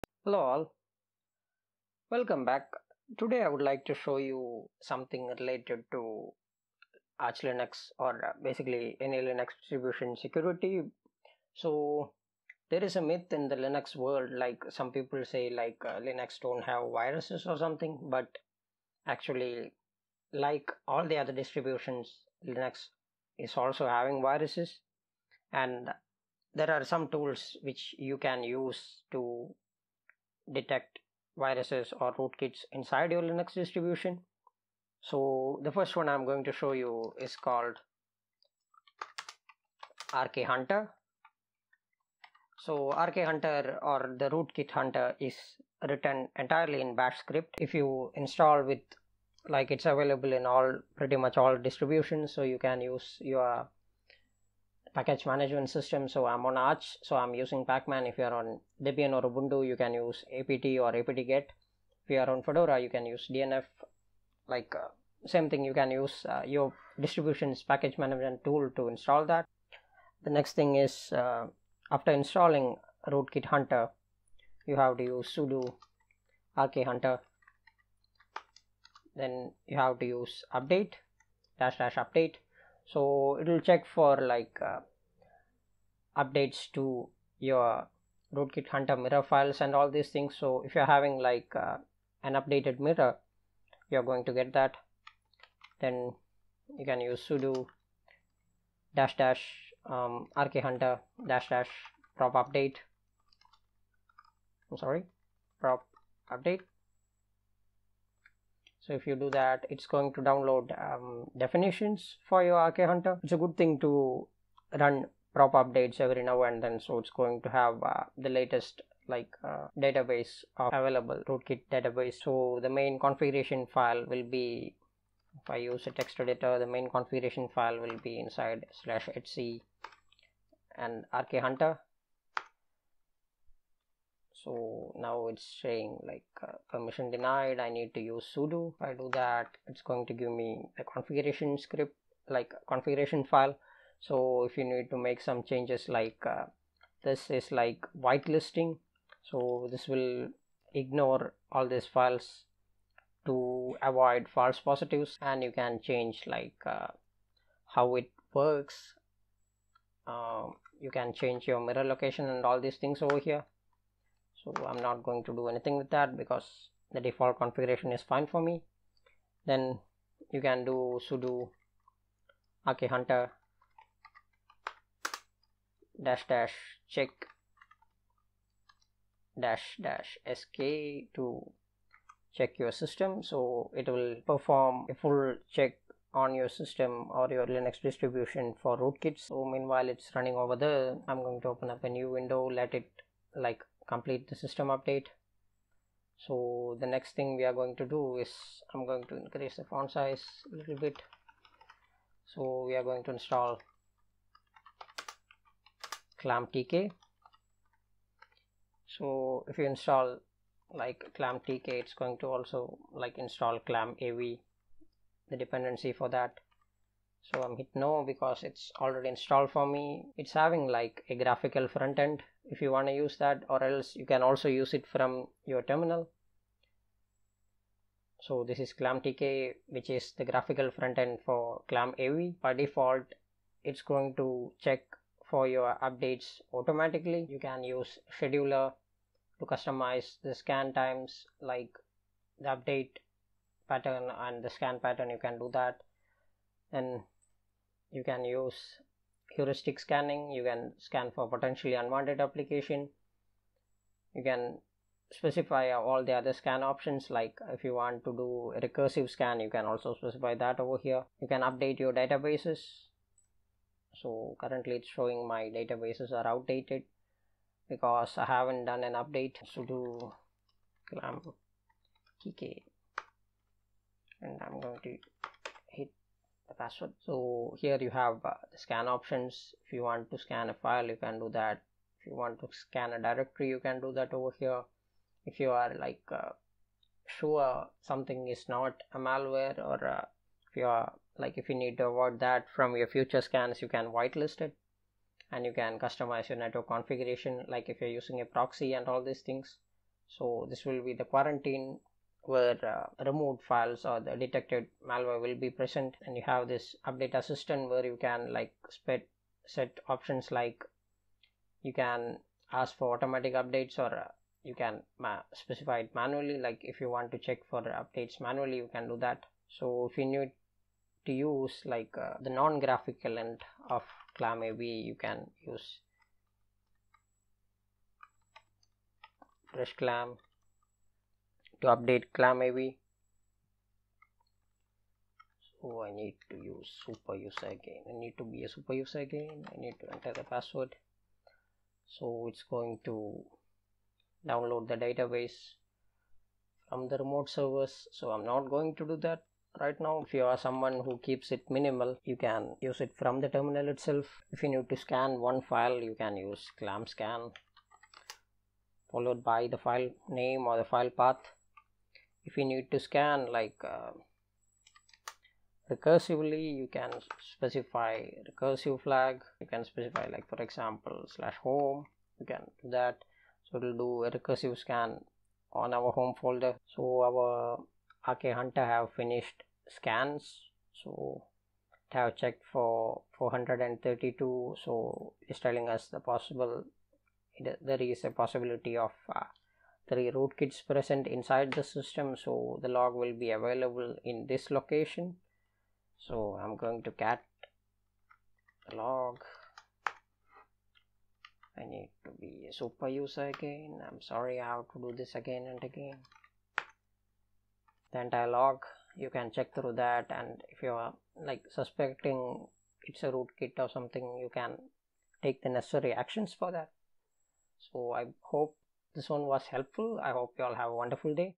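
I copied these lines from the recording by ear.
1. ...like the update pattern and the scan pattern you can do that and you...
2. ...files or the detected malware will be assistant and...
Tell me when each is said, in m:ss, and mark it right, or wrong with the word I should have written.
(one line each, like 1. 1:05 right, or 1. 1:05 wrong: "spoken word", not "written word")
1. 4:01 right
2. 5:03 wrong: "present", not "assistant".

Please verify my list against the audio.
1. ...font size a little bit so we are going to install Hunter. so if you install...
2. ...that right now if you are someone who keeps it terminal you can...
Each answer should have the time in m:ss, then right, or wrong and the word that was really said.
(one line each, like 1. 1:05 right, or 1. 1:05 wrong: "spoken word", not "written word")
1. 3:19 wrong: "ClamTK", not "Hunter"
2. 5:49 wrong: "minimal", not "terminal".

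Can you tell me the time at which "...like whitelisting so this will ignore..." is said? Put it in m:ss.
2:27.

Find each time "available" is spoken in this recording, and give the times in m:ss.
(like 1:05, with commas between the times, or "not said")
0:49, 2:00, 6:33.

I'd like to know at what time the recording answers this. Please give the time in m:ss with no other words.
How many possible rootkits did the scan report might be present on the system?
6:29.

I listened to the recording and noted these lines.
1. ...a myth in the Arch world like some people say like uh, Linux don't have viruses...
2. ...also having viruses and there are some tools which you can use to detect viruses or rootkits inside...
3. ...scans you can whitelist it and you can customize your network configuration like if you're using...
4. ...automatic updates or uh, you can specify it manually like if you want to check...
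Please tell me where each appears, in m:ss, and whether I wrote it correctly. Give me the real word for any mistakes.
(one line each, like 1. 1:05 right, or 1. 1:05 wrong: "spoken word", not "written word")
1. 0:12 wrong: "Linux", not "Arch"
2. 0:23 right
3. 4:53 right
4. 5:12 right.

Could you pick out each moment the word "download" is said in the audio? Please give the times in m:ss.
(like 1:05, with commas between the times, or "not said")
1:50, 5:44.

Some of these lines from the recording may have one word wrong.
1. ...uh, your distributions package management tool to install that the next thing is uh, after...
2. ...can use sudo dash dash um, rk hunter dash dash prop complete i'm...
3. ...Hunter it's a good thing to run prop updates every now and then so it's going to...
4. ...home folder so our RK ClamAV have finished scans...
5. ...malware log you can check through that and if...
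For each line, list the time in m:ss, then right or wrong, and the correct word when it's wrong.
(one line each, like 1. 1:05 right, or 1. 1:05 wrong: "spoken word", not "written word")
1. 1:06 right
2. 1:36 wrong: "update", not "complete"
3. 1:52 right
4. 6:15 wrong: "Hunter", not "ClamAV"
5. 6:48 wrong: "entire", not "malware".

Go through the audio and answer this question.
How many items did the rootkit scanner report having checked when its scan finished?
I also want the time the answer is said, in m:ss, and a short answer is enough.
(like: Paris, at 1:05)
432, at 6:23.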